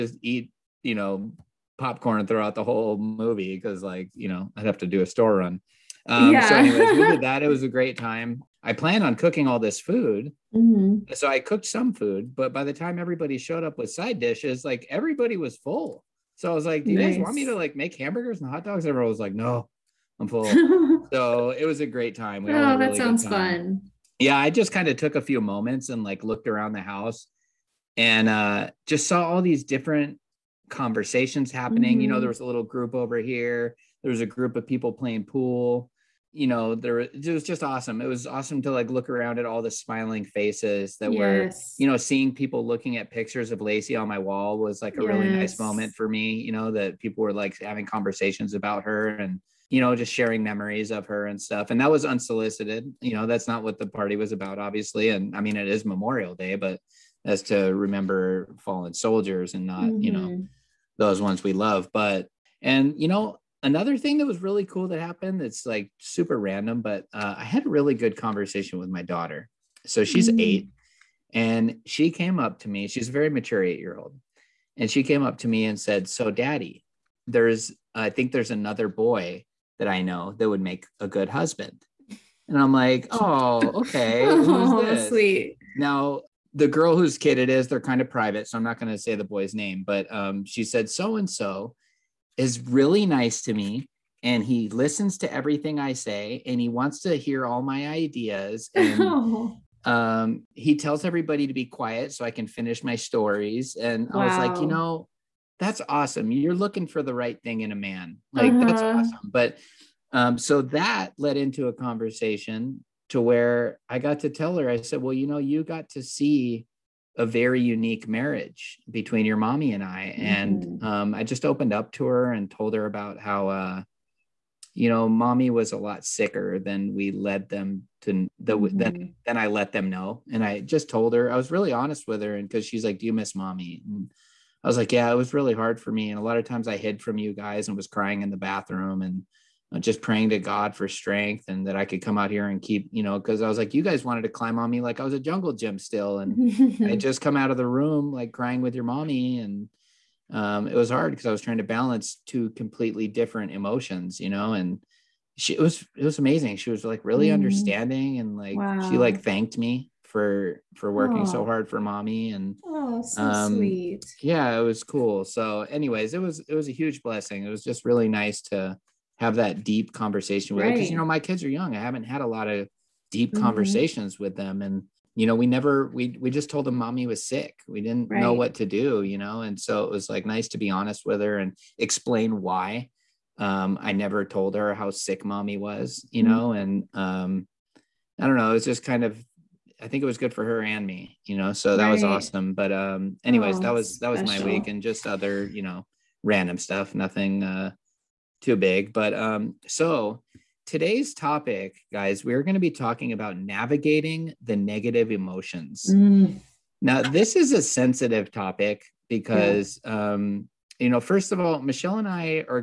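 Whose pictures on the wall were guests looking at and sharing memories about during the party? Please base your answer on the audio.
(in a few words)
Lacey.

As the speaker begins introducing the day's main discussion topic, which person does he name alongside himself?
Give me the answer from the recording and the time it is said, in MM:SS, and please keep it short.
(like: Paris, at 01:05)
Michelle, at 03:31.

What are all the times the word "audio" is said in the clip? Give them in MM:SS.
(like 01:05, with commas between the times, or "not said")
not said.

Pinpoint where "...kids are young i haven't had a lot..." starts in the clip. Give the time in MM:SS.
02:51.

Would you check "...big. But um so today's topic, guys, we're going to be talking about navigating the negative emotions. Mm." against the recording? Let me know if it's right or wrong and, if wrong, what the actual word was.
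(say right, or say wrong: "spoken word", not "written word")
right.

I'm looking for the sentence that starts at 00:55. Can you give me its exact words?
And I mean, it is Memorial Day, but as to remember fallen soldiers and not, mm-hmm.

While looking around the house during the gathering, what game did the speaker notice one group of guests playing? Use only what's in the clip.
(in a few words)
Pool.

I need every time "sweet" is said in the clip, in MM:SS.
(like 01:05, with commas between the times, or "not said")
01:25, 02:43.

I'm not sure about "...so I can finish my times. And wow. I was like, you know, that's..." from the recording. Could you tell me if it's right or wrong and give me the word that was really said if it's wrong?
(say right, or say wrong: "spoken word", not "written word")
wrong: "stories", not "times".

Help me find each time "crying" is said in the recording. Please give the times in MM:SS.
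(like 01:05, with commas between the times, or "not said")
02:17, 02:28.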